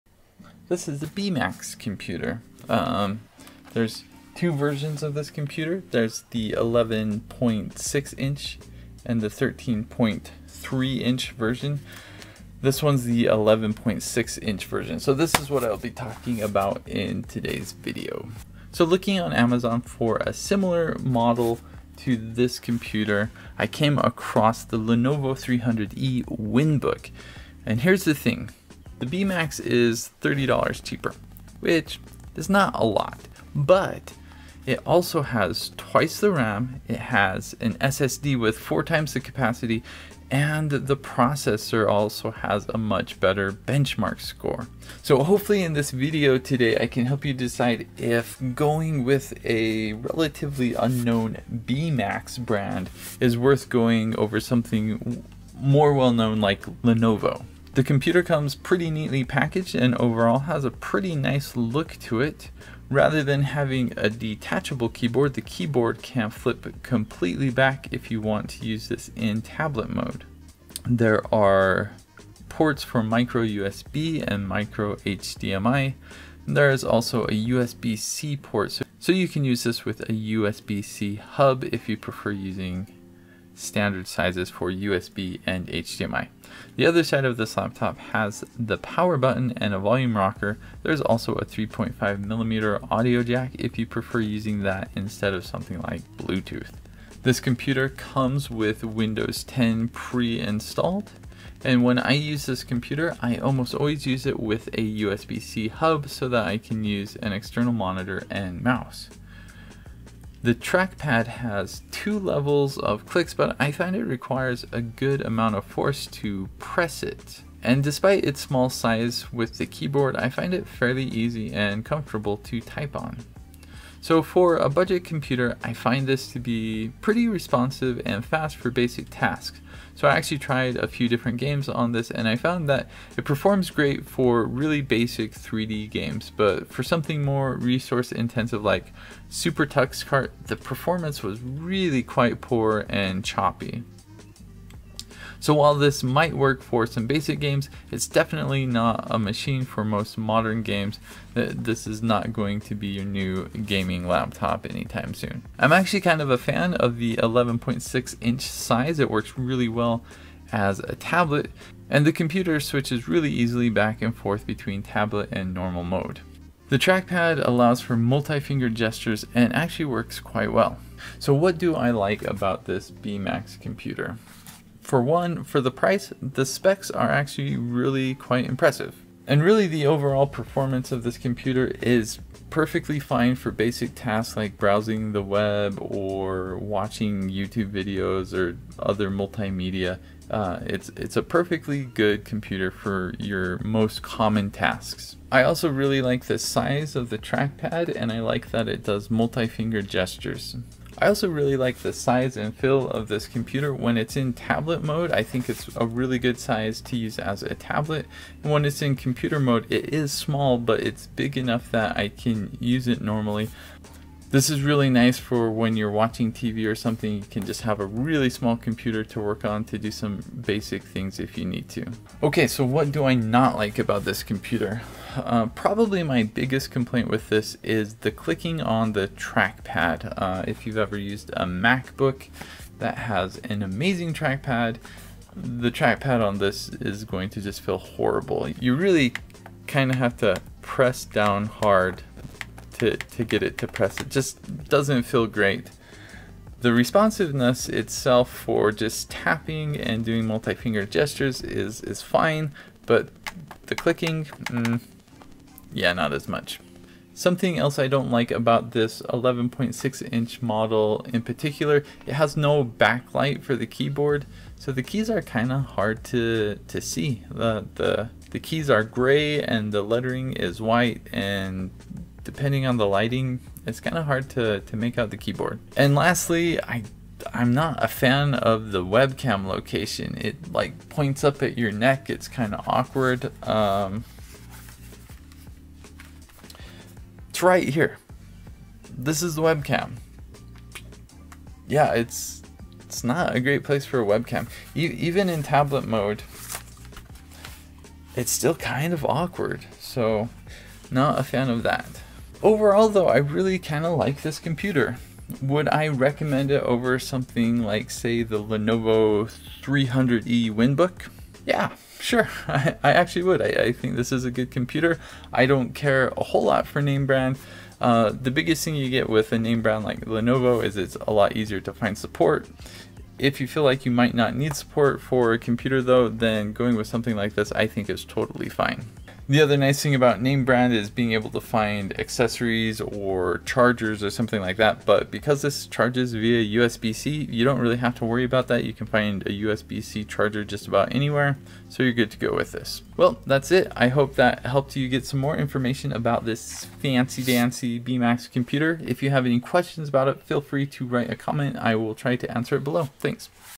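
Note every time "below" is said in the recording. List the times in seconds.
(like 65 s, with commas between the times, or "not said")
352 s.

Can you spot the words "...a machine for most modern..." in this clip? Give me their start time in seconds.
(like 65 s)
149 s.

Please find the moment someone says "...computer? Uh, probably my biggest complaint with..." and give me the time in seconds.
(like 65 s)
224 s.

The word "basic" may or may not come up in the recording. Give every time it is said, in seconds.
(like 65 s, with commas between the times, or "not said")
128 s, 134 s, 147 s, 183 s, 220 s.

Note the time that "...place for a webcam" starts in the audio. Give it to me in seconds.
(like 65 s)
293 s.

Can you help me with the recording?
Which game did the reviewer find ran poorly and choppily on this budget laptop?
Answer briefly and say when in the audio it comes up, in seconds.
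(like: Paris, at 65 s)
SuperTuxKart, at 139 s.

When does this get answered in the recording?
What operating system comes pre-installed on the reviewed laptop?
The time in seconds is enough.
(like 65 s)
98 s.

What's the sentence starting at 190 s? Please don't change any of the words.
Uh, it's, it's a perfectly good computer for your most common tasks.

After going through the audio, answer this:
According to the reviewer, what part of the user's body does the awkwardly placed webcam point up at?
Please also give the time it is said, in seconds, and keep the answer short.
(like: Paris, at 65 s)
neck, at 281 s.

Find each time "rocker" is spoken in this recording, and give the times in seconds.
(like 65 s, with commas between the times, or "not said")
90 s.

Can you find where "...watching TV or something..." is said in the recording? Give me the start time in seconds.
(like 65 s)
215 s.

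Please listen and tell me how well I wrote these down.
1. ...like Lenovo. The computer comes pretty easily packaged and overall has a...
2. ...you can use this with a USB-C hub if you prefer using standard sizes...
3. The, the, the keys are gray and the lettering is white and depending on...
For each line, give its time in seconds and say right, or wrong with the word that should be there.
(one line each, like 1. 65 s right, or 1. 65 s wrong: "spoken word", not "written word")
1. 56 s wrong: "neatly", not "easily"
2. 79 s right
3. 267 s right.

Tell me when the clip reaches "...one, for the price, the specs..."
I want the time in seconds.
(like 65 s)
175 s.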